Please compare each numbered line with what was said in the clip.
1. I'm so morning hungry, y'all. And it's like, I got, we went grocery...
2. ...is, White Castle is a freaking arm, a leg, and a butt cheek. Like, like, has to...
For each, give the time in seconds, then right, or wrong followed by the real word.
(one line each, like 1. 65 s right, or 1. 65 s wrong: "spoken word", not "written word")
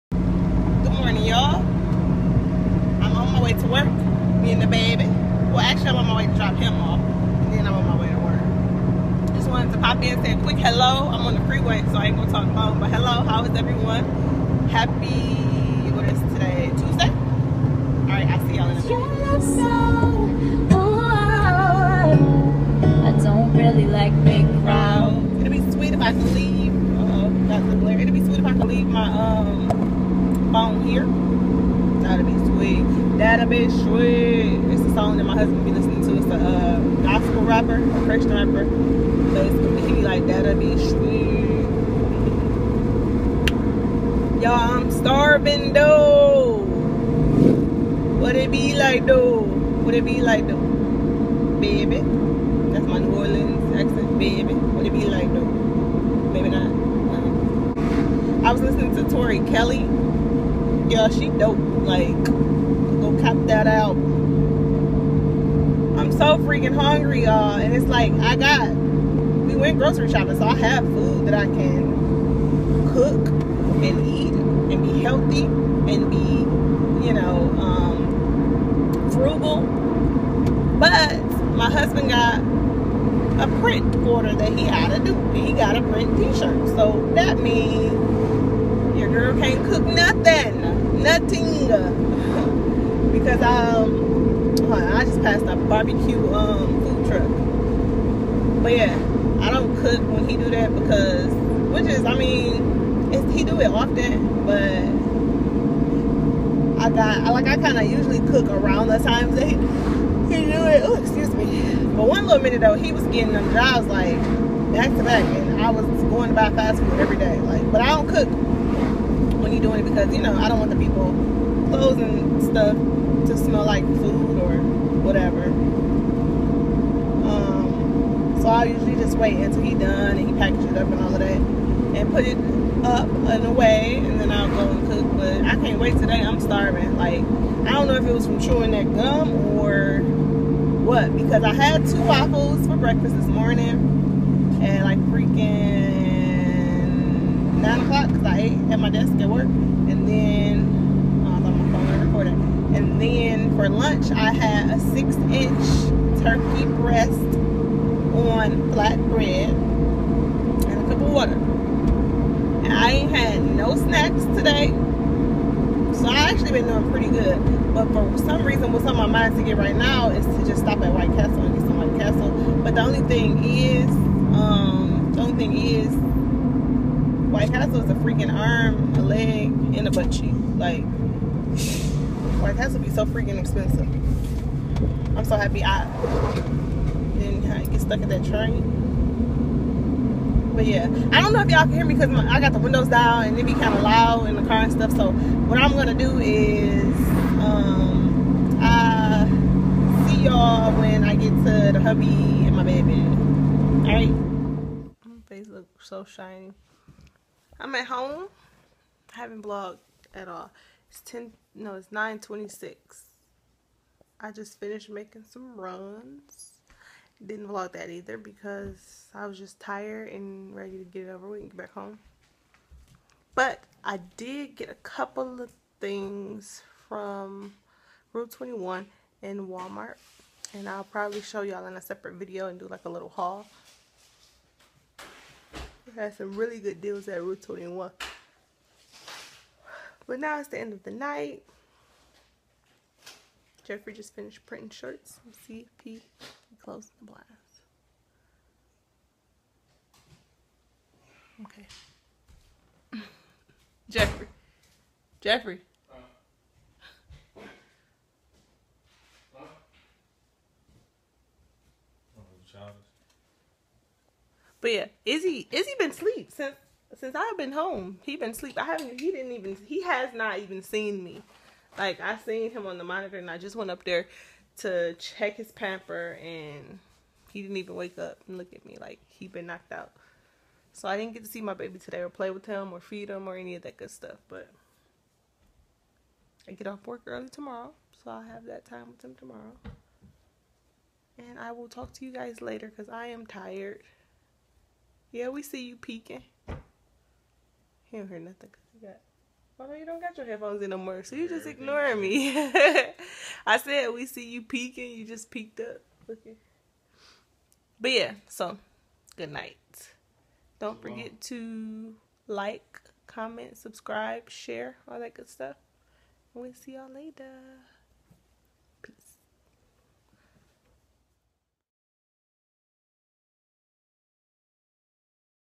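1. 66 s wrong: "freaking", not "morning"
2. 175 s right.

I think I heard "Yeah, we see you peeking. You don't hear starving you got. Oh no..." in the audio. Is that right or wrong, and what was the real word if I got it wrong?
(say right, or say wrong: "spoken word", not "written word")
wrong: "nothing", not "starving".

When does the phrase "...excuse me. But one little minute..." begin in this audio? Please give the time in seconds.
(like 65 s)
111 s.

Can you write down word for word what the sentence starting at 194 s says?
So what I'm gonna do is, um, I see y'all when I get to the hubby and my baby.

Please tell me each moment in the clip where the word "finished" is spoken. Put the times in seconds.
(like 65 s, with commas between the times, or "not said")
214 s, 244 s.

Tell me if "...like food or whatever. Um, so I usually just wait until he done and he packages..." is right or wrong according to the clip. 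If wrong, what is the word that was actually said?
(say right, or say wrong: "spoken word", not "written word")
right.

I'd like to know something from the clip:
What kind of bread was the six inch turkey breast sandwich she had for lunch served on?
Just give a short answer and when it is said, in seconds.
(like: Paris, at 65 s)
flat bread, at 158 s.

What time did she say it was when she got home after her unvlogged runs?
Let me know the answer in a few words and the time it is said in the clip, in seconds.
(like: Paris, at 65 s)
9:26, at 211 s.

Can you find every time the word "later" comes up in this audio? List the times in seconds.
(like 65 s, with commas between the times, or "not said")
292 s, 316 s.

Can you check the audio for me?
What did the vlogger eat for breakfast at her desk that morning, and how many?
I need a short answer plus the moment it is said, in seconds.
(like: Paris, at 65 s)
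2 waffles, at 141 s.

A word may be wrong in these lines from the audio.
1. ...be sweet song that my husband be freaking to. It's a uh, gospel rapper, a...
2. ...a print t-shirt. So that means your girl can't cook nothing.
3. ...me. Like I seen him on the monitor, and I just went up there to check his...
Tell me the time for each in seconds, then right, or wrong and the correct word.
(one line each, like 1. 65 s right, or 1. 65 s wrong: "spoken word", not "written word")
1. 33 s wrong: "listening", not "freaking"
2. 85 s right
3. 271 s right.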